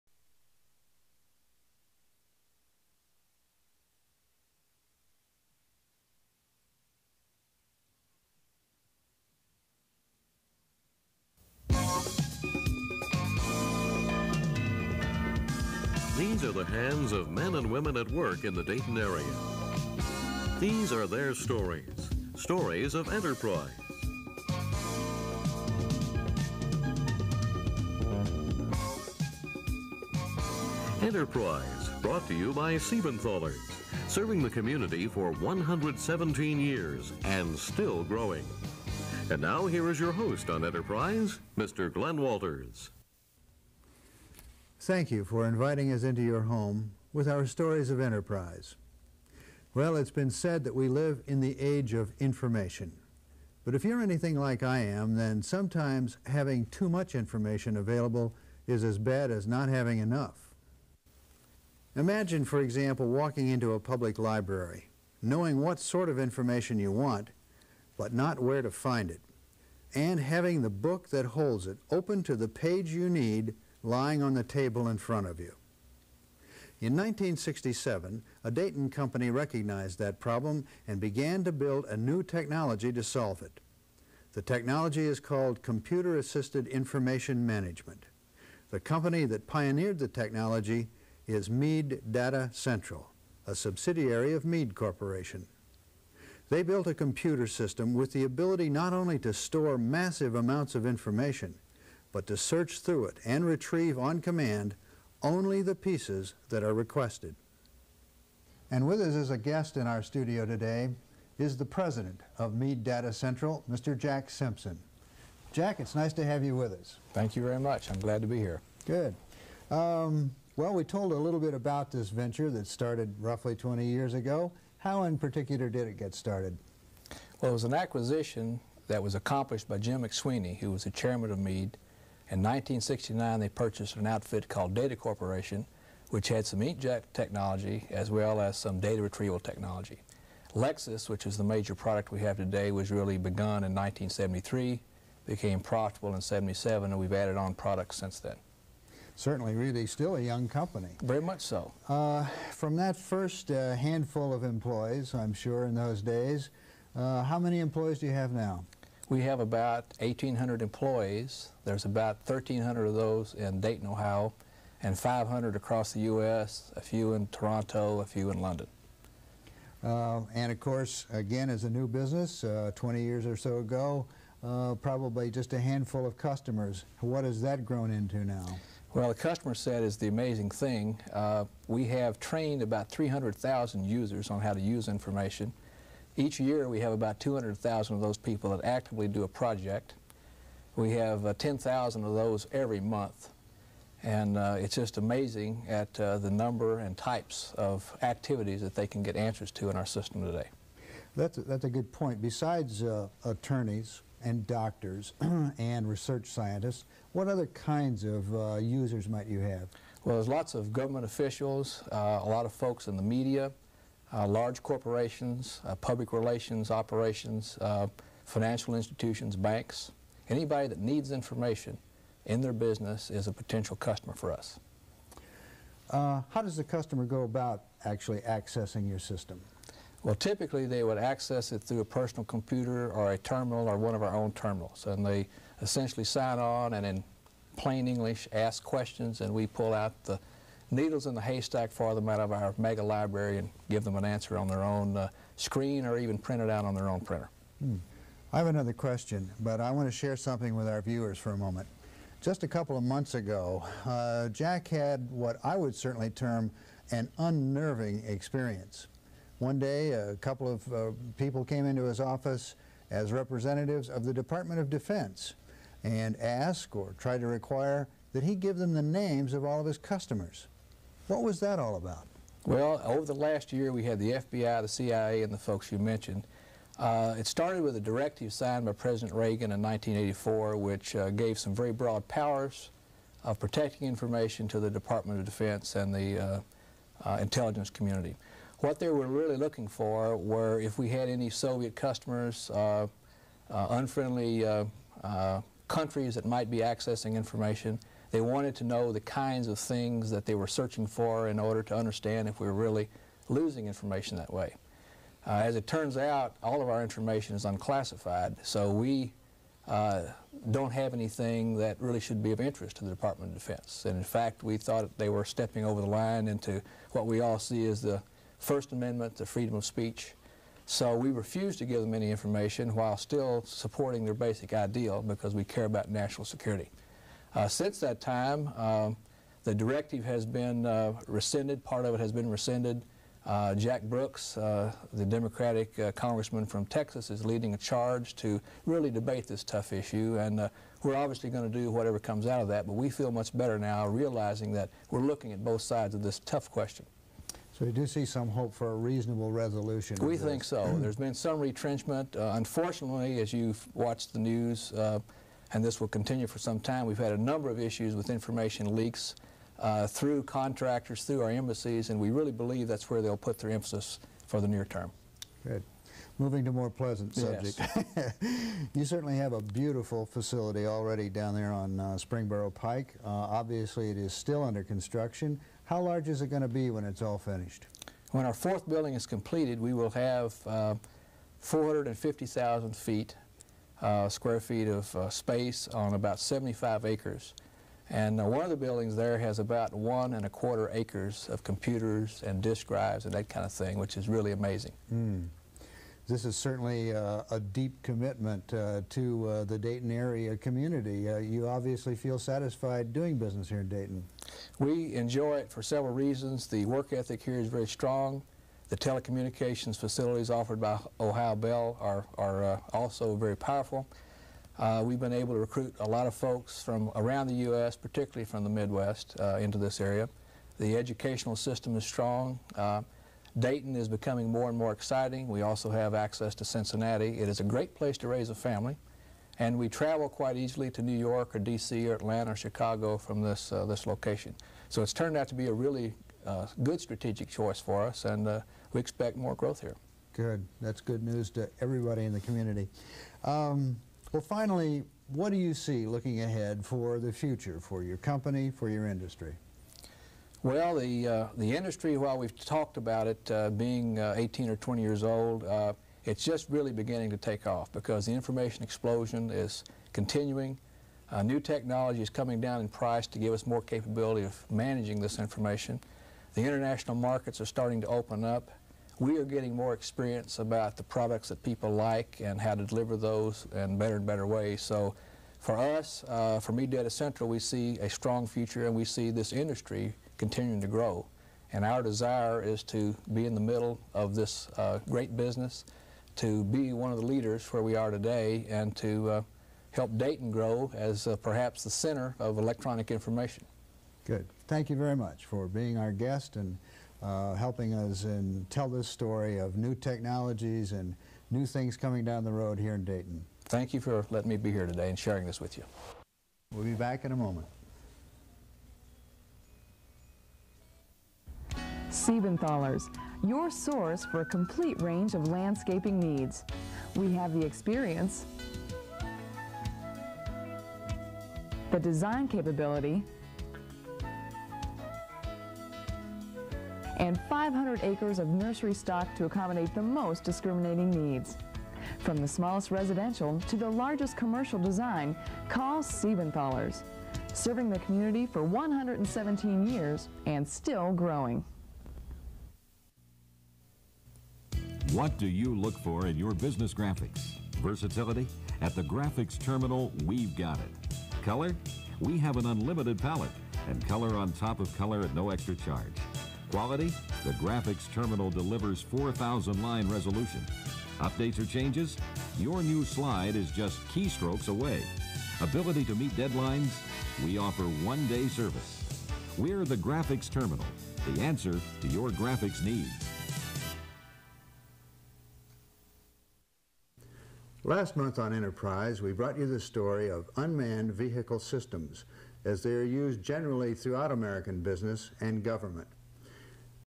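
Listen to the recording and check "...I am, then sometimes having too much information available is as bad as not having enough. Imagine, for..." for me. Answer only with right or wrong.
right.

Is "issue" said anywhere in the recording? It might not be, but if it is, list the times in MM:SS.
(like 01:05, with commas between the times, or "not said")
05:39, 05:57.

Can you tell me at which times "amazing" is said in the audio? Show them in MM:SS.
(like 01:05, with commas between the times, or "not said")
03:00, 03:14, 06:34.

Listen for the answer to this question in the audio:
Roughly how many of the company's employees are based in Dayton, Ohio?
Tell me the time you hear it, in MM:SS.
02:42.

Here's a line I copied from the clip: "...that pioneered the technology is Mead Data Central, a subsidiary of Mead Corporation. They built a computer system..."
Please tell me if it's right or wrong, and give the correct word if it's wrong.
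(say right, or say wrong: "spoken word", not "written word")
right.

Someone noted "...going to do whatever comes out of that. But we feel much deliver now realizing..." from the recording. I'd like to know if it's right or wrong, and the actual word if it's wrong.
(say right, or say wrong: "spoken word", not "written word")
wrong: "better", not "deliver".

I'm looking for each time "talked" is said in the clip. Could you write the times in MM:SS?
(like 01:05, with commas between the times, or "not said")
07:32.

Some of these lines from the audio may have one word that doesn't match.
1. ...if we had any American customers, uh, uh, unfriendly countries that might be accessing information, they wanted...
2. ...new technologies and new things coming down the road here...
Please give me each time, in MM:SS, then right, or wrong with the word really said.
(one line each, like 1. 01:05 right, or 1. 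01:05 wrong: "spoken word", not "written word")
1. 04:50 wrong: "Soviet", not "American"
2. 08:19 right.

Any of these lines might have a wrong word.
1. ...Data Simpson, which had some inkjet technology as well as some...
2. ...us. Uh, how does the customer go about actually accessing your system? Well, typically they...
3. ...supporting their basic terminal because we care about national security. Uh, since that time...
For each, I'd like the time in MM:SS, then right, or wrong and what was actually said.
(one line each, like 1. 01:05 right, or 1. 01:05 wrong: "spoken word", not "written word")
1. 02:14 wrong: "Corporation", not "Simpson"
2. 03:44 right
3. 05:23 wrong: "ideal", not "terminal".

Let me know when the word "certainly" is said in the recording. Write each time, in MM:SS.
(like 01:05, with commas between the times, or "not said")
02:29, 04:15, 06:08, 06:36.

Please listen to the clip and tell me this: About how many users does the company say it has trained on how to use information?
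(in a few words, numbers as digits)
300,000.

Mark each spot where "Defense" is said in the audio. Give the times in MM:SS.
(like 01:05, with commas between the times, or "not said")
04:24, 04:45, 05:13.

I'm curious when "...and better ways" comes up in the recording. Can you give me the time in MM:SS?
07:53.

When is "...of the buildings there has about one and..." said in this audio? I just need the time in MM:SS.
06:28.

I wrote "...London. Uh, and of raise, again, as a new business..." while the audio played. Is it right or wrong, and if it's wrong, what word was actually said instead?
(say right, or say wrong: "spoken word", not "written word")
wrong: "course", not "raise".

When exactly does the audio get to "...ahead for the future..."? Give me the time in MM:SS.
07:26.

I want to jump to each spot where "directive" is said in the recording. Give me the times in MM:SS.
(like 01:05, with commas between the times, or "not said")
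04:37, 05:29.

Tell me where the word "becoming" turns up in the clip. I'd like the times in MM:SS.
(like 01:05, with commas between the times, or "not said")
07:03.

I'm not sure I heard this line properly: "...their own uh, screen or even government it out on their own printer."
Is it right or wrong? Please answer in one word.
wrong.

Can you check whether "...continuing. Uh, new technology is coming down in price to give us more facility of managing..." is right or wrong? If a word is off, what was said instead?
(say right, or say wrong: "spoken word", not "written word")
wrong: "capability", not "facility".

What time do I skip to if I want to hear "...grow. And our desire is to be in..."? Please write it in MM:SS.
08:00.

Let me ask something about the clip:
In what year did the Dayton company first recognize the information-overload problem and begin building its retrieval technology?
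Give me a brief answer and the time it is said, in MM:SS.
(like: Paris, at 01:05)
1967, at 01:16.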